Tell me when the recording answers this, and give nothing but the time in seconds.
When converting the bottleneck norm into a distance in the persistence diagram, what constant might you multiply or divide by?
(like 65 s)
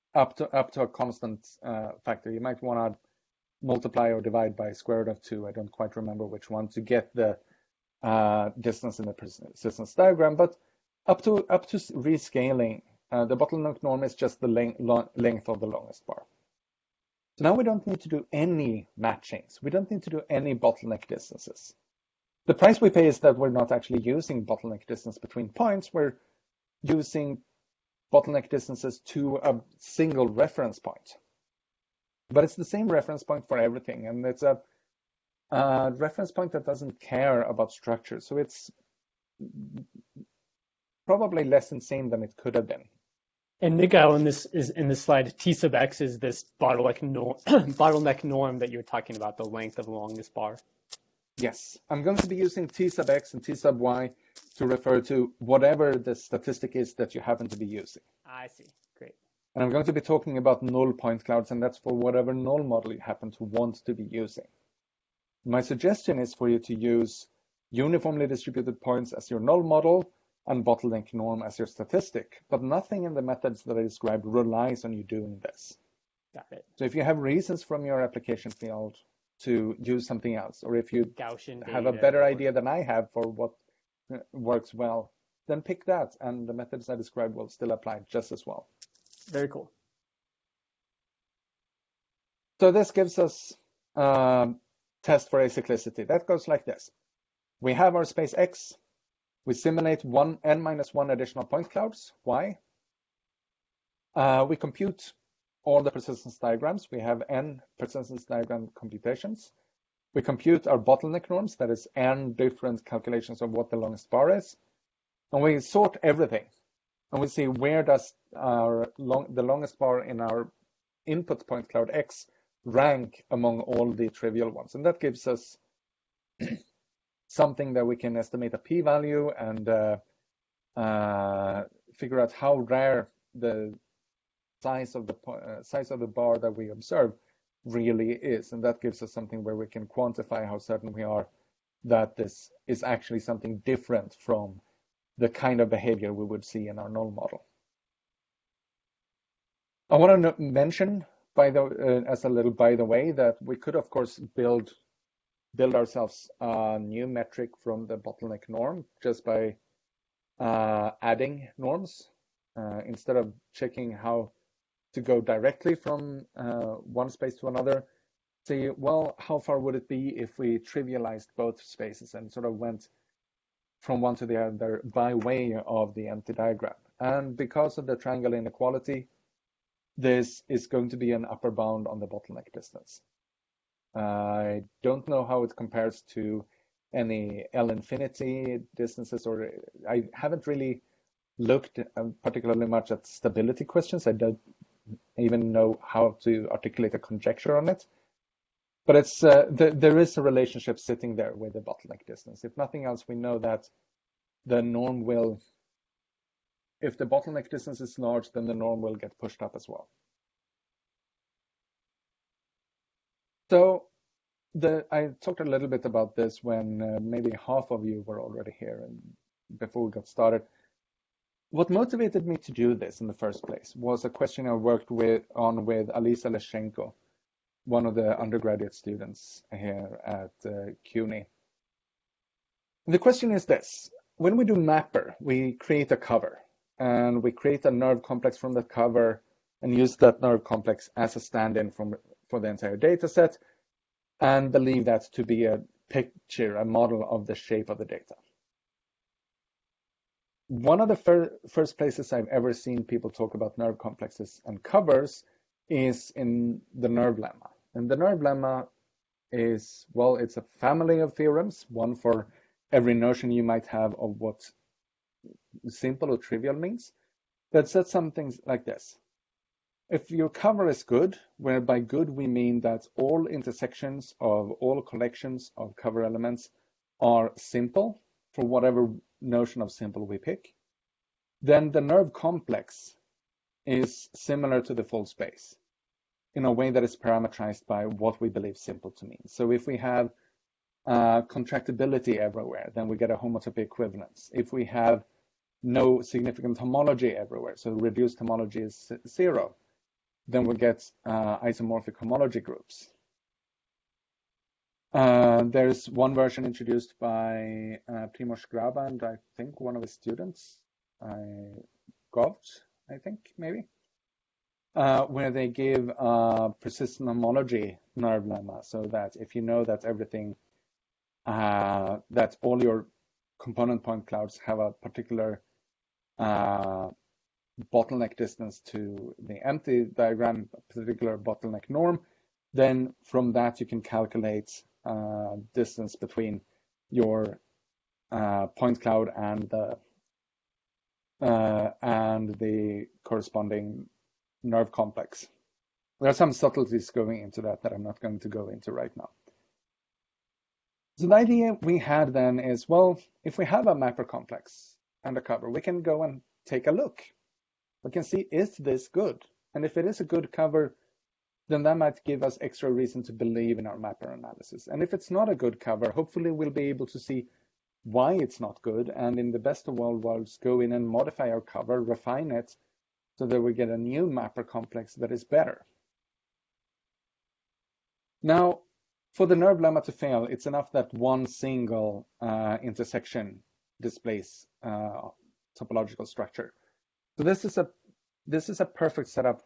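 4 s.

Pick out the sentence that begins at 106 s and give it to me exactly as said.
We have n persistence diagram computations.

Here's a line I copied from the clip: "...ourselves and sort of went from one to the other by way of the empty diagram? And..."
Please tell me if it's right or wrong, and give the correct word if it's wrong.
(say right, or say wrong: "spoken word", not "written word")
wrong: "spaces", not "ourselves".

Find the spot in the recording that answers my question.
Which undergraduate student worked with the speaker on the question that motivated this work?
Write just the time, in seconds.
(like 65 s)
225 s.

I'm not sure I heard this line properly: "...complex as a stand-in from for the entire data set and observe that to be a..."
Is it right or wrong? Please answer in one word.
wrong.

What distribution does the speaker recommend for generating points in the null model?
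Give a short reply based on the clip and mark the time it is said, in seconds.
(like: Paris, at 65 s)
uniformly distributed, at 67 s.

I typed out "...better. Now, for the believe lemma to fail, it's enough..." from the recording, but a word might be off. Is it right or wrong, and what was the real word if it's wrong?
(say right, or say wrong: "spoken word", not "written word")
wrong: "nerve", not "believe".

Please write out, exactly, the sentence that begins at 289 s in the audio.
So if we have uh, contractibility everywhere, then we get a homotopy equivalence.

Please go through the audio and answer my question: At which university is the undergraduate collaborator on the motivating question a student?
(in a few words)
CUNY.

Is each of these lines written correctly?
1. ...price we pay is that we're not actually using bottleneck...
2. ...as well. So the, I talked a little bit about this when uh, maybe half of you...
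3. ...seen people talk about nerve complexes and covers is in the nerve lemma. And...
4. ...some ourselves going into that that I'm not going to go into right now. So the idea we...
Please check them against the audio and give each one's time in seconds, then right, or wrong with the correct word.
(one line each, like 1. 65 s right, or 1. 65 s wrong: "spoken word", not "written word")
1. 22 s right
2. 209 s right
3. 252 s right
4. 346 s wrong: "subtleties", not "ourselves".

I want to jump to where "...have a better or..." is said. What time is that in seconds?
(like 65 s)
81 s.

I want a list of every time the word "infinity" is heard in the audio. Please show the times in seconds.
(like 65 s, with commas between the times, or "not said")
187 s.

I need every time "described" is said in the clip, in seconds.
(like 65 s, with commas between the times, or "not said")
73 s, 86 s.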